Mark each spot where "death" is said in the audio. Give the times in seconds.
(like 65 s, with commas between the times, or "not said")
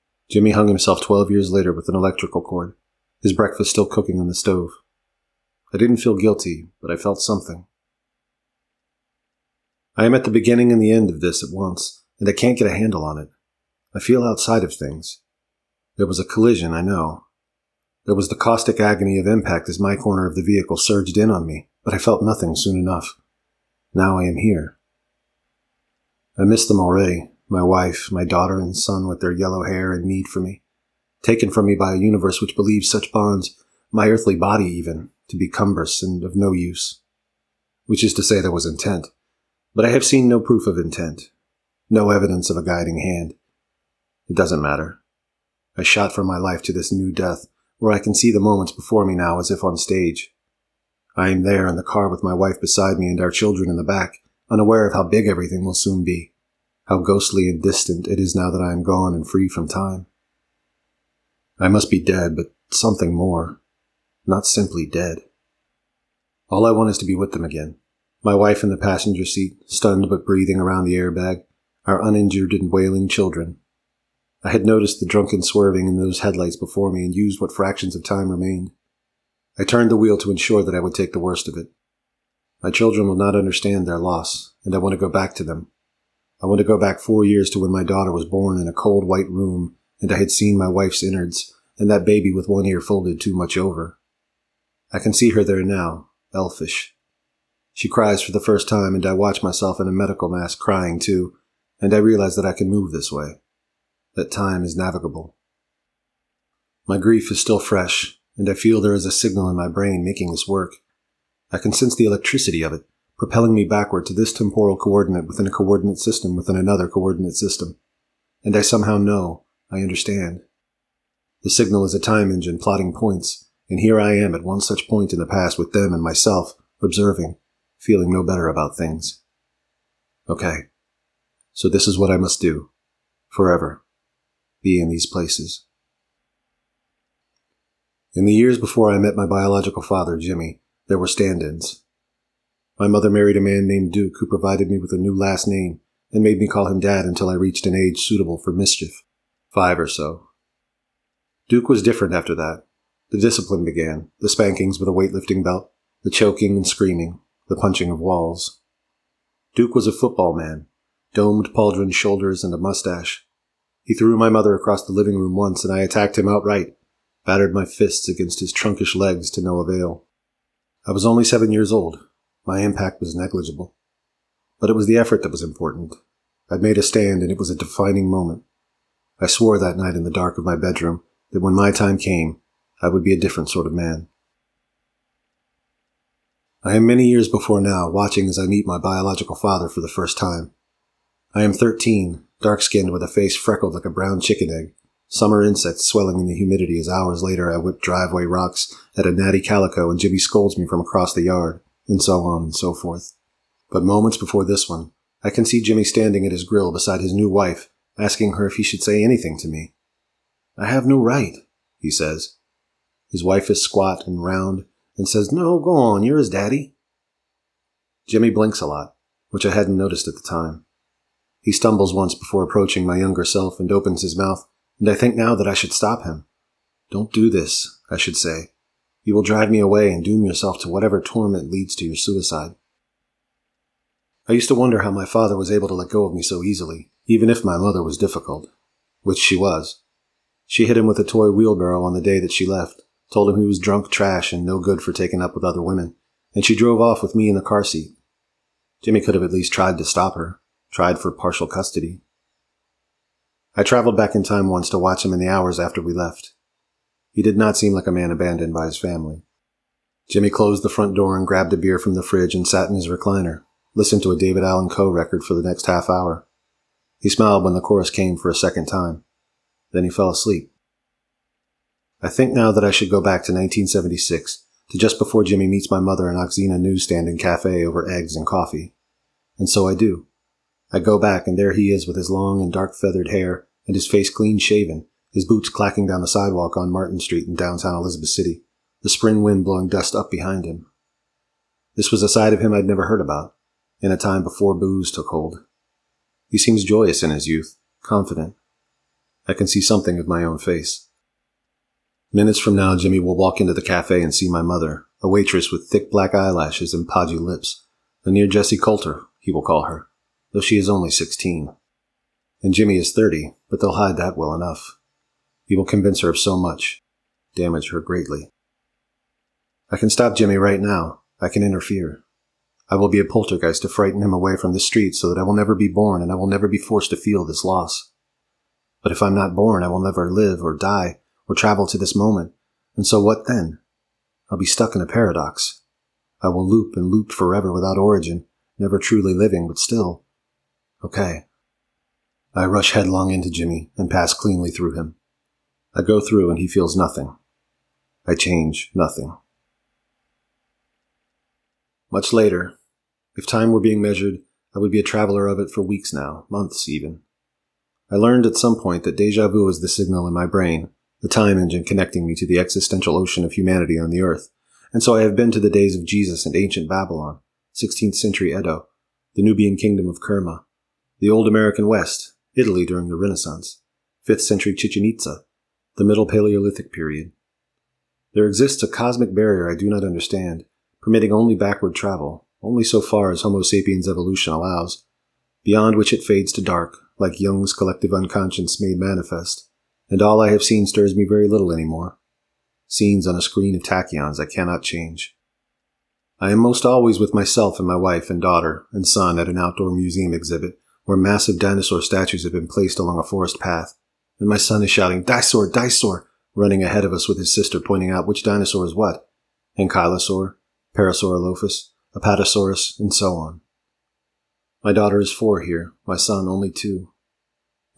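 47 s.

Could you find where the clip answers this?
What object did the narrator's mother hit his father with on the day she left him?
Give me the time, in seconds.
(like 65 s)
241 s.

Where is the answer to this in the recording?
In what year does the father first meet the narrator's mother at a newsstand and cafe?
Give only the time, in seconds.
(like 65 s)
273 s.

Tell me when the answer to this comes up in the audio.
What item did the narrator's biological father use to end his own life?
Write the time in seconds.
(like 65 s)
1 s.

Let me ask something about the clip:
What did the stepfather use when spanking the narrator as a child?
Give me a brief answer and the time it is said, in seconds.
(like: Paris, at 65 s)
weightlifting belt, at 154 s.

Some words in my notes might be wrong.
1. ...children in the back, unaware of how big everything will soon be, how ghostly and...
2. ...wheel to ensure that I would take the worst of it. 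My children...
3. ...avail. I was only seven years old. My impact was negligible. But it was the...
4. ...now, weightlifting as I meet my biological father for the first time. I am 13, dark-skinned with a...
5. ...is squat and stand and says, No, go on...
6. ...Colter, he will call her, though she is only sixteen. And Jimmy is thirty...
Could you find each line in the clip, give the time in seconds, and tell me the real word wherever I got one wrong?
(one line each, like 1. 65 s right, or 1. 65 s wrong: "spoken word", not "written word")
1. 53 s right
2. 79 s right
3. 169 s right
4. 187 s wrong: "watching", not "weightlifting"
5. 213 s wrong: "round", not "stand"
6. 308 s right.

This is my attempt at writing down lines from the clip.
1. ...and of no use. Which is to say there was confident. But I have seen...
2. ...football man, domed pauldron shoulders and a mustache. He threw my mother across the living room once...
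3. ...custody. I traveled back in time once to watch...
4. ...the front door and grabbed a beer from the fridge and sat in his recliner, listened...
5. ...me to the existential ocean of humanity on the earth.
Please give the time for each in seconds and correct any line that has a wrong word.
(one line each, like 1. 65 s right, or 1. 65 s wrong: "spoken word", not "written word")
1. 36 s wrong: "intent", not "confident"
2. 159 s right
3. 251 s right
4. 260 s right
5. 362 s right.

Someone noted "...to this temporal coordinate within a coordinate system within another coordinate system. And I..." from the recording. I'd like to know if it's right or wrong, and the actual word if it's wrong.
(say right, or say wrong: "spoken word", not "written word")
right.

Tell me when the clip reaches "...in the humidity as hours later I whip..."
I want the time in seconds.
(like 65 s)
196 s.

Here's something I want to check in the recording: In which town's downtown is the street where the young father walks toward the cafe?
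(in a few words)
Elizabeth City.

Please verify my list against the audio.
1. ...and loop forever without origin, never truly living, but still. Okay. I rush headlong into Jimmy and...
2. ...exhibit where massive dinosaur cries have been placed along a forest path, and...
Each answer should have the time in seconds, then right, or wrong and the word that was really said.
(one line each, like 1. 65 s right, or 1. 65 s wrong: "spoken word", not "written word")
1. 336 s right
2. 400 s wrong: "statues", not "cries".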